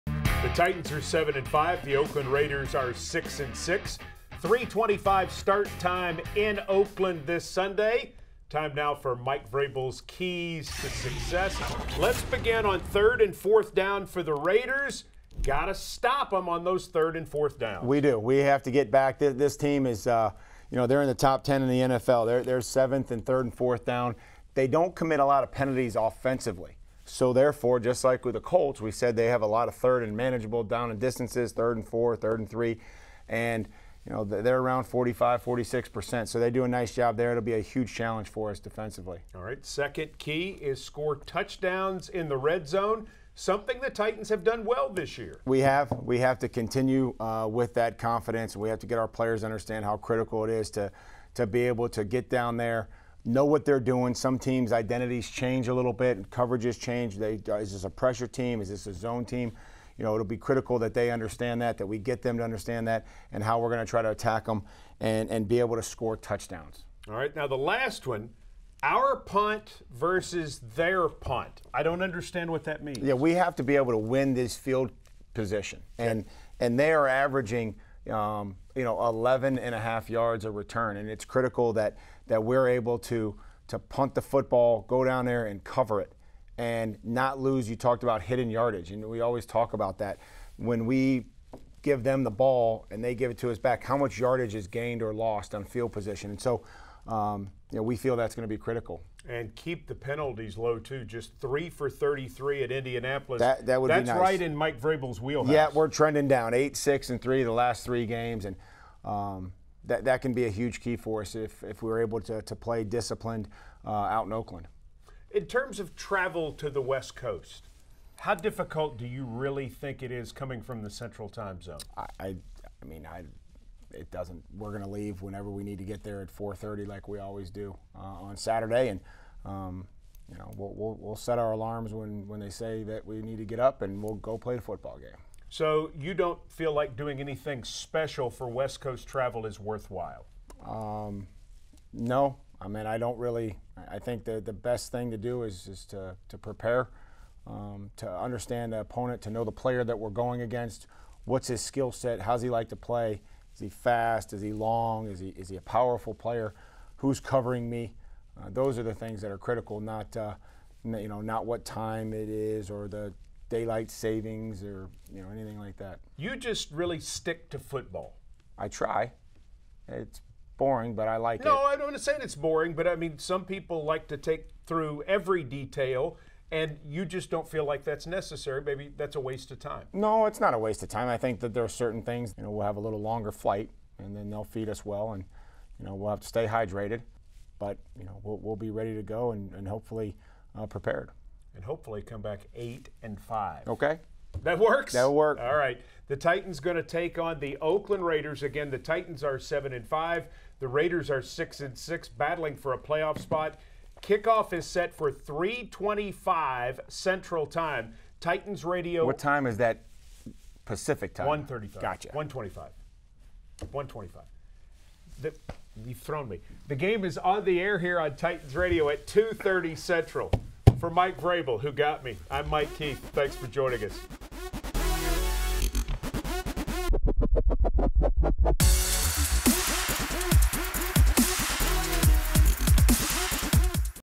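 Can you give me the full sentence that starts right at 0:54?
Some teams' identities change a little bit, coverages change.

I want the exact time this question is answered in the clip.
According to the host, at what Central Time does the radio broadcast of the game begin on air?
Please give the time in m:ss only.
3:39.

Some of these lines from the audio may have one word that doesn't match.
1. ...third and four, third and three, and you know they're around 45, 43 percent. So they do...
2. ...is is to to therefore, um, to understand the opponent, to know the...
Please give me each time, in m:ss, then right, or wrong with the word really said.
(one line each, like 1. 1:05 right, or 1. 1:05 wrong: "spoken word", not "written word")
1. 0:31 wrong: "46", not "43"
2. 2:25 wrong: "prepare", not "therefore".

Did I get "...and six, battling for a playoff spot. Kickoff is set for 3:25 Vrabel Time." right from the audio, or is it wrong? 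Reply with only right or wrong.
wrong.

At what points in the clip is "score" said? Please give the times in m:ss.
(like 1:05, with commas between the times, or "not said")
0:40, 1:05.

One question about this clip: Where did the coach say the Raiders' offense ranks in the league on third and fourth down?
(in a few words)
7th.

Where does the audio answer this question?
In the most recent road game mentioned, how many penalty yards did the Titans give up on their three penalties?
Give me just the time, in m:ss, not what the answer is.
1:41.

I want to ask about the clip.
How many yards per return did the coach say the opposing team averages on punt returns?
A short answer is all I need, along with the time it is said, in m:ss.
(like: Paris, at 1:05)
11.5, at 1:19.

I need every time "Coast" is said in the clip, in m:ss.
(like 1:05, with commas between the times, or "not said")
1:57, 2:18.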